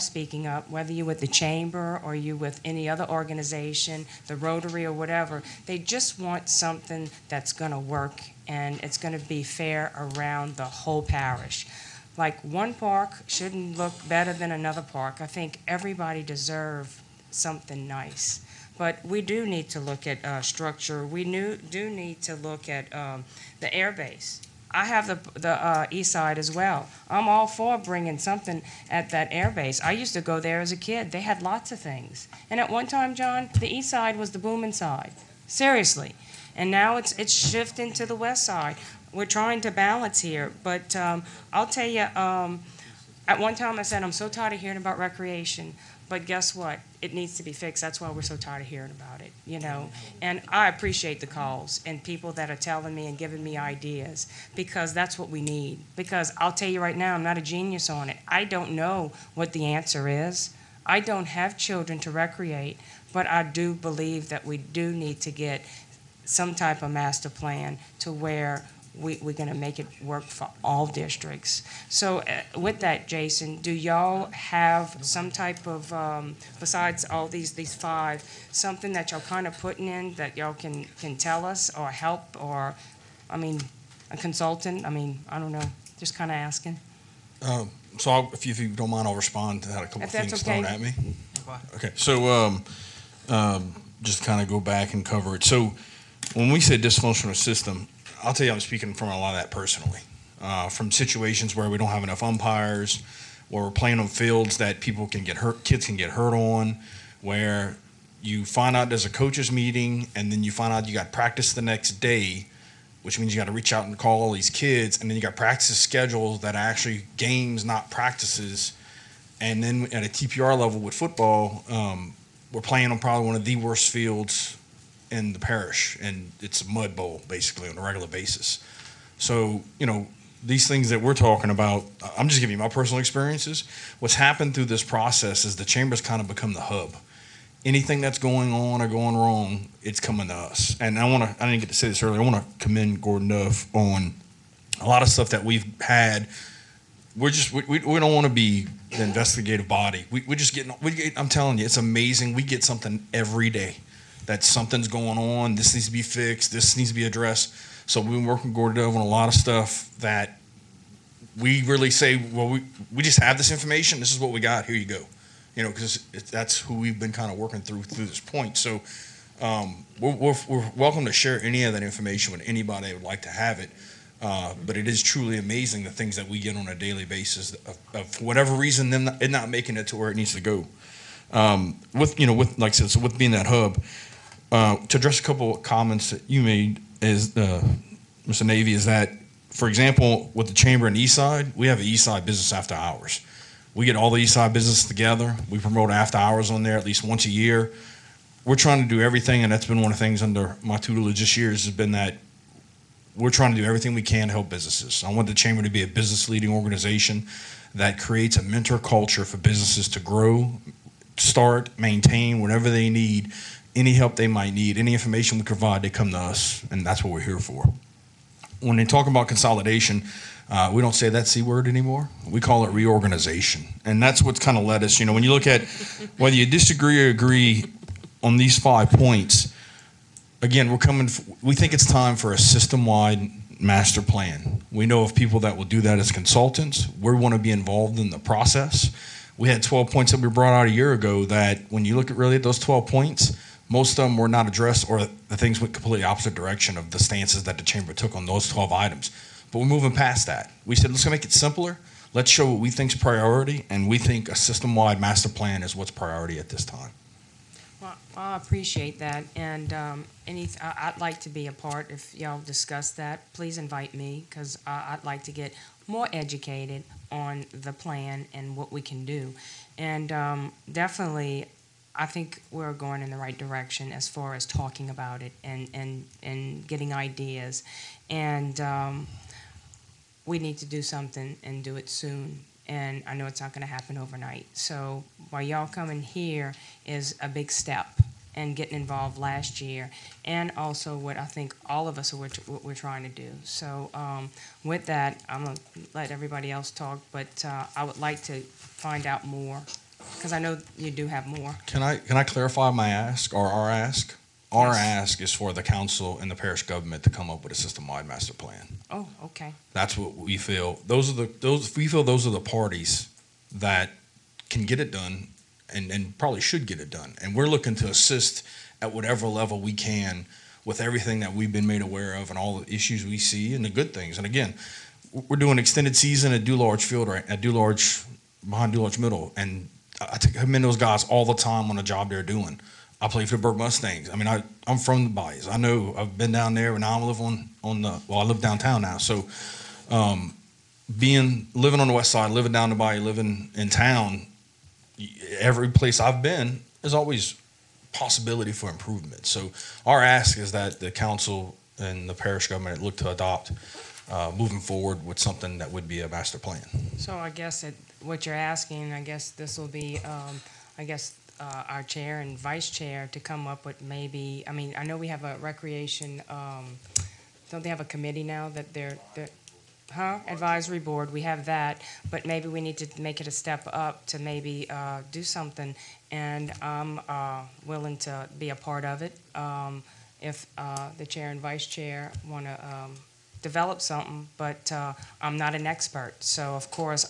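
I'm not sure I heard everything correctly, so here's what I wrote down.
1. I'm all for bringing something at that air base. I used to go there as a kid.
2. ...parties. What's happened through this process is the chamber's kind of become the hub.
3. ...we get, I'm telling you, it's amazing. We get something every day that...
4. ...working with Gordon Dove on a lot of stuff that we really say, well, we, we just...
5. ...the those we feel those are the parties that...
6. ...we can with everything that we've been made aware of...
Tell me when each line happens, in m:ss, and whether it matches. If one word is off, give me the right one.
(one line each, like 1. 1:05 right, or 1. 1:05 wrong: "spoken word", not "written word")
1. 0:27 right
2. 2:12 wrong: "experiences", not "parties"
3. 2:30 right
4. 2:38 right
5. 5:11 right
6. 5:19 right.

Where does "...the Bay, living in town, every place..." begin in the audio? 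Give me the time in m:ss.
5:42.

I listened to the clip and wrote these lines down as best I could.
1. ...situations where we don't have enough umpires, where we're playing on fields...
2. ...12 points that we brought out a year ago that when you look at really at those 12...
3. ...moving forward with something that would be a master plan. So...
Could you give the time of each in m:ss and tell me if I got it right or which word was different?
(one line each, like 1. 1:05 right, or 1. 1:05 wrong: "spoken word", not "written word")
1. 1:40 right
2. 3:59 right
3. 5:54 right.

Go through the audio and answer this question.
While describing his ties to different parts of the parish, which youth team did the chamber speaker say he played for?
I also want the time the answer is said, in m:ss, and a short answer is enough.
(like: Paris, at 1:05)
Burke Mustangs, at 5:33.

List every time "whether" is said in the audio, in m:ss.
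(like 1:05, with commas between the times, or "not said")
0:00, 3:46.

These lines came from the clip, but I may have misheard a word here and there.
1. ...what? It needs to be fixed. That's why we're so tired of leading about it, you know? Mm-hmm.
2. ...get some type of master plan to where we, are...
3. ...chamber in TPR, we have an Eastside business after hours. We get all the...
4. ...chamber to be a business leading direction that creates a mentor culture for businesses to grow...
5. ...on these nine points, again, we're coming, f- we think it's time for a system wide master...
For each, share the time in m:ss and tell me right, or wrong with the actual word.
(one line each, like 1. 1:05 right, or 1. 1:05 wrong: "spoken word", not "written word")
1. 0:46 wrong: "hearing", not "leading"
2. 1:05 right
3. 3:10 wrong: "Eastside", not "TPR"
4. 3:25 wrong: "organization", not "direction"
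5. 3:48 wrong: "five", not "nine".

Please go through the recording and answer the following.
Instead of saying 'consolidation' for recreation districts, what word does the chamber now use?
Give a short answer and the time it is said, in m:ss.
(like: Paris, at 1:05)
reorganization, at 3:42.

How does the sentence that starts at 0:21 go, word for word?
We knew, do need to look at um, the air base.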